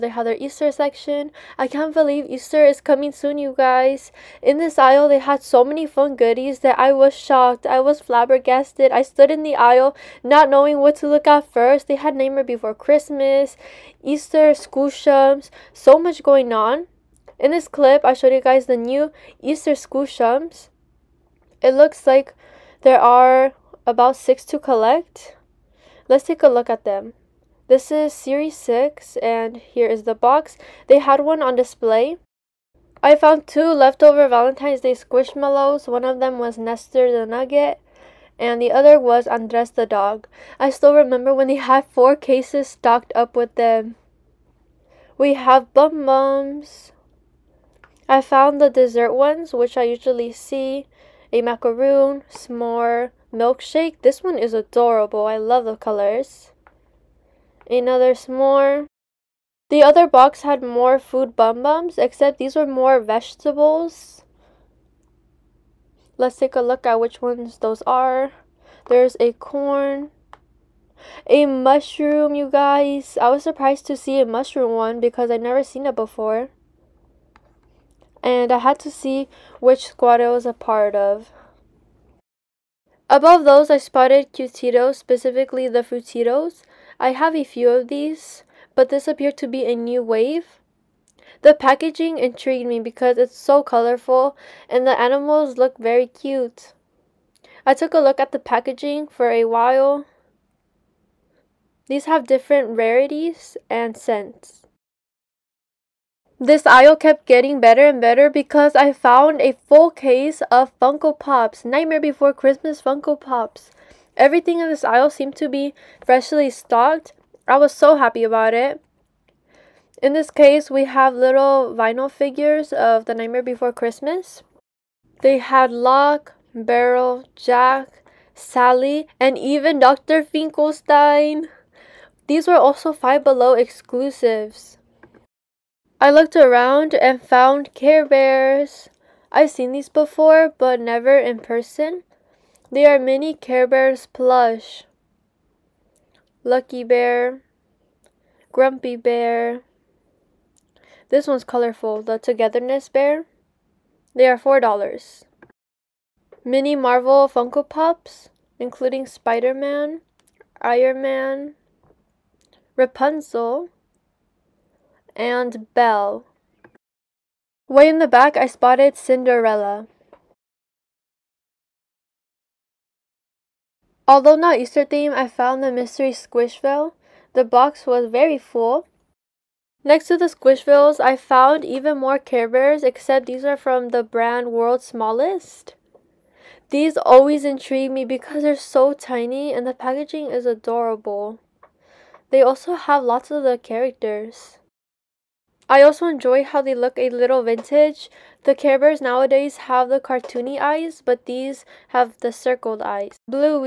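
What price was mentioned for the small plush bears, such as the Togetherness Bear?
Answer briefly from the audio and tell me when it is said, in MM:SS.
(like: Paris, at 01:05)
$4, at 02:34.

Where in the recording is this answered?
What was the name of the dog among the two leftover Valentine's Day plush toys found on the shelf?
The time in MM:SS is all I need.
00:39.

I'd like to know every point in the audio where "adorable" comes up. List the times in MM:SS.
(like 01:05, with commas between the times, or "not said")
00:54, 03:10.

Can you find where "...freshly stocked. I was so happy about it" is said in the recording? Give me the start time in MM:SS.
01:56.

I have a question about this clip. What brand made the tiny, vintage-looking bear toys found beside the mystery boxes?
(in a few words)
World's Smallest.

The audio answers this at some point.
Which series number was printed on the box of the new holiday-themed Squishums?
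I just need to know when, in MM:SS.
00:28.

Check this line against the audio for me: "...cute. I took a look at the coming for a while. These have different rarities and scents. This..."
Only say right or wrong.
wrong.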